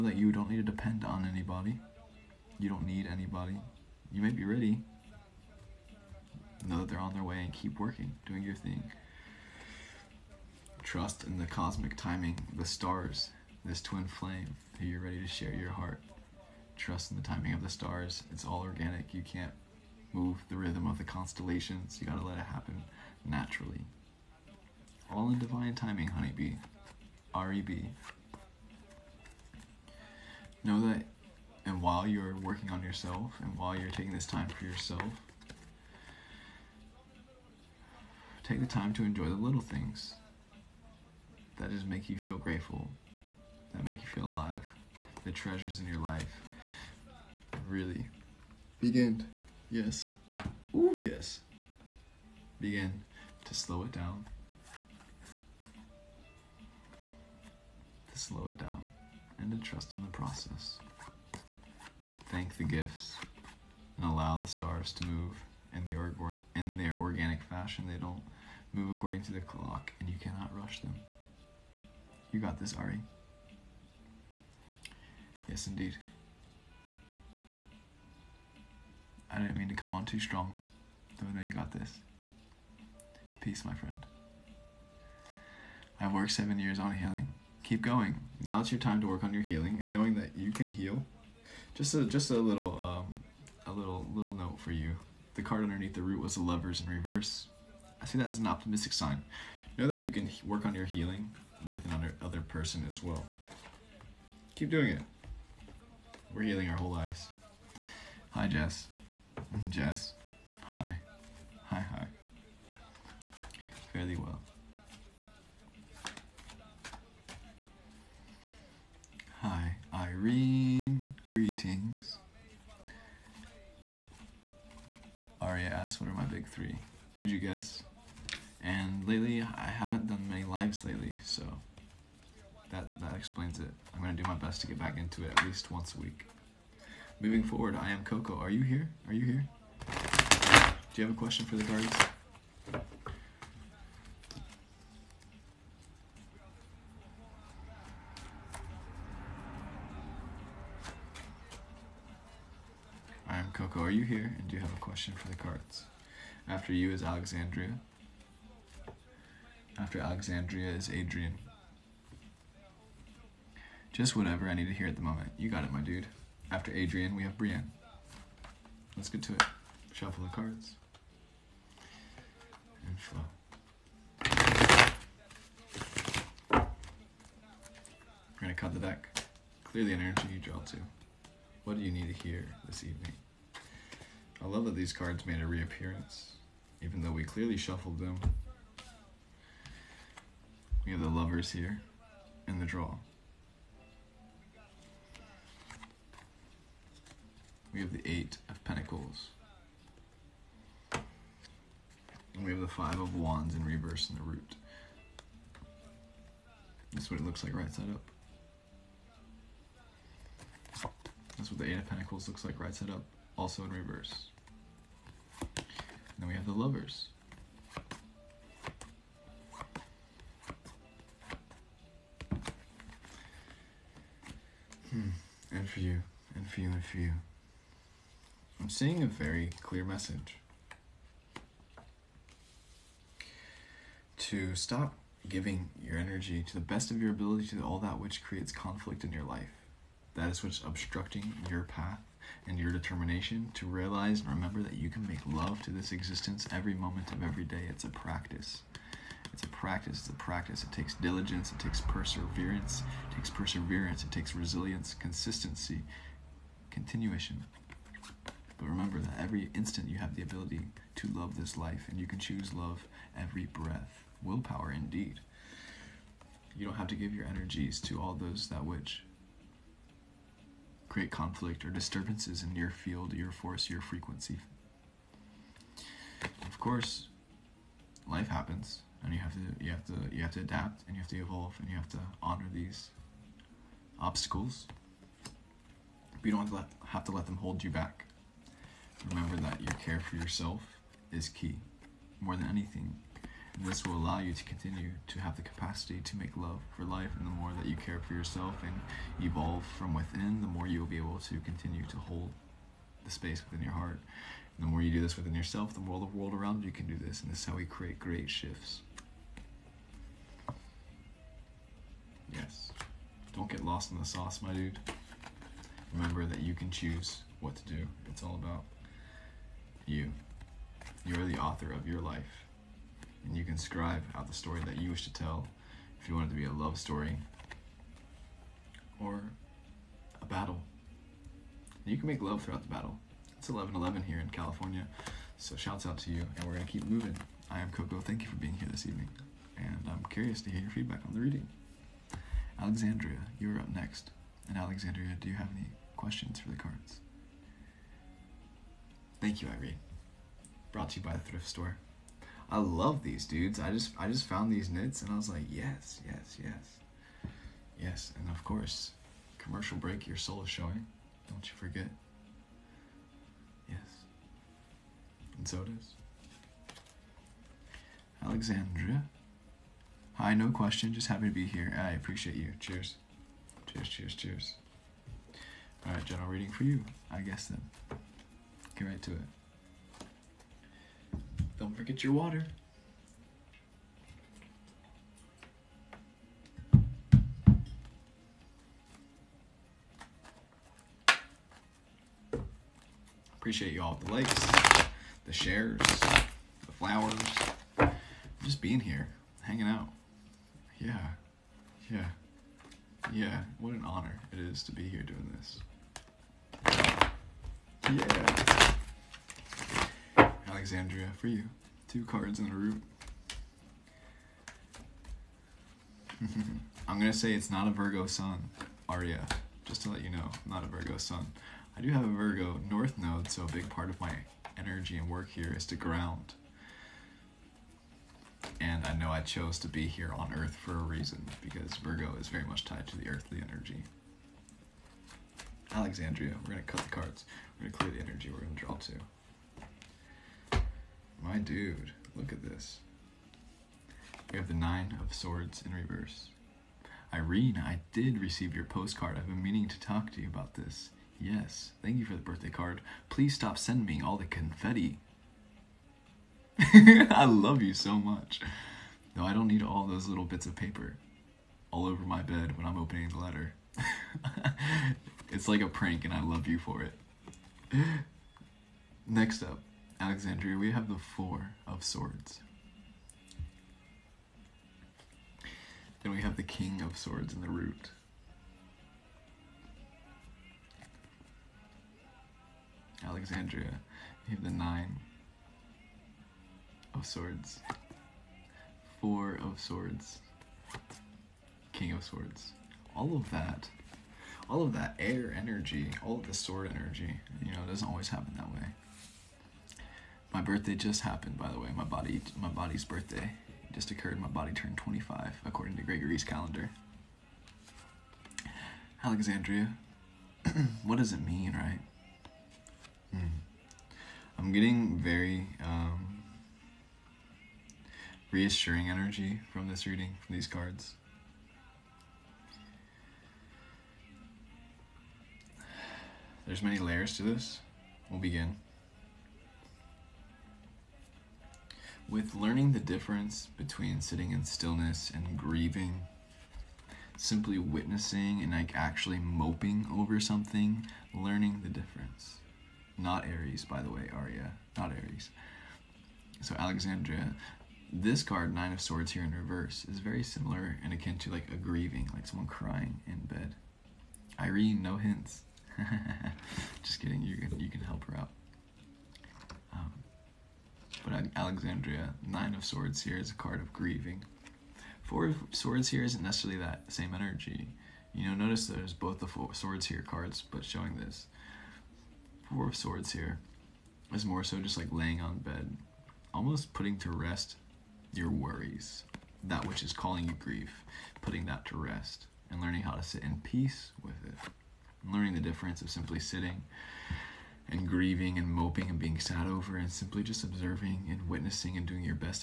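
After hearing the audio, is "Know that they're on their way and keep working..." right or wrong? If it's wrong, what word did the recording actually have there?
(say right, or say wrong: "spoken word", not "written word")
right.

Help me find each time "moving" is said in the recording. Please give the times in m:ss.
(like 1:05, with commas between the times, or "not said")
2:17, 5:36.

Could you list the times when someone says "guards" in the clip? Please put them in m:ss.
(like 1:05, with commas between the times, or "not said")
2:21.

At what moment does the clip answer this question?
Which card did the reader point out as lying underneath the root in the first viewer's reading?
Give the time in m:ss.
1:36.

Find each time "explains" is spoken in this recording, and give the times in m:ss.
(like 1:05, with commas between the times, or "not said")
2:13.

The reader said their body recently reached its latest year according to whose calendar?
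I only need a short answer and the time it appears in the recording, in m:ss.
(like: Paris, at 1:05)
Gregory's calendar, at 8:25.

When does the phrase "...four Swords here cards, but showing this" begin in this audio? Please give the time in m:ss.
9:29.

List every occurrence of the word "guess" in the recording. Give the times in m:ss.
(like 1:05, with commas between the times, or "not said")
2:07, 6:17.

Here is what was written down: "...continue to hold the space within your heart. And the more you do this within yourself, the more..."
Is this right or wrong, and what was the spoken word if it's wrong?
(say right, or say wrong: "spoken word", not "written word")
right.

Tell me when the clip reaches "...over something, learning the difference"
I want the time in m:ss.
8:59.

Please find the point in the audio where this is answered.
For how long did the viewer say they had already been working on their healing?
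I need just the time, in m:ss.
1:26.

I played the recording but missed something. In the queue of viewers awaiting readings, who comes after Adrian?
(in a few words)
Brienne.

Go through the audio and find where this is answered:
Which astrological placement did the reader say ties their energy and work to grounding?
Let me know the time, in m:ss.
7:02.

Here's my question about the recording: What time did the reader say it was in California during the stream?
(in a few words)
11:11.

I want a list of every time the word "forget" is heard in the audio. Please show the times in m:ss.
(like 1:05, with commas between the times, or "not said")
6:01, 6:21.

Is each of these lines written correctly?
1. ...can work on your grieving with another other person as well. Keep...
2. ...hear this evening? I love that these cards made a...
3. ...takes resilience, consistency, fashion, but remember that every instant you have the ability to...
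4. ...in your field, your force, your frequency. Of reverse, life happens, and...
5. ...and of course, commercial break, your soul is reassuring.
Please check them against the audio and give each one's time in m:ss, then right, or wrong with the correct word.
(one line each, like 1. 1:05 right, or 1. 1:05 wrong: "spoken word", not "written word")
1. 1:40 wrong: "healing", not "grieving"
2. 3:02 right
3. 4:14 wrong: "continuation", not "fashion"
4. 4:32 wrong: "course", not "reverse"
5. 5:58 wrong: "showing", not "reassuring".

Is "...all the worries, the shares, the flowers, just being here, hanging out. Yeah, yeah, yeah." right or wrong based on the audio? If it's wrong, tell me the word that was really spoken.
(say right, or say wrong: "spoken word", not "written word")
wrong: "likes", not "worries".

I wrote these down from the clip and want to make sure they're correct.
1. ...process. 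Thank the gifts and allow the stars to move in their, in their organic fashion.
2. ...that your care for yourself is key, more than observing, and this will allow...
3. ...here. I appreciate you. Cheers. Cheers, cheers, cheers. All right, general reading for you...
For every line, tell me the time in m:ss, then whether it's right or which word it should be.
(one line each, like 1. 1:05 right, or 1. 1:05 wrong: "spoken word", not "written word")
1. 1:00 right
2. 4:49 wrong: "anything", not "observing"
3. 6:11 right.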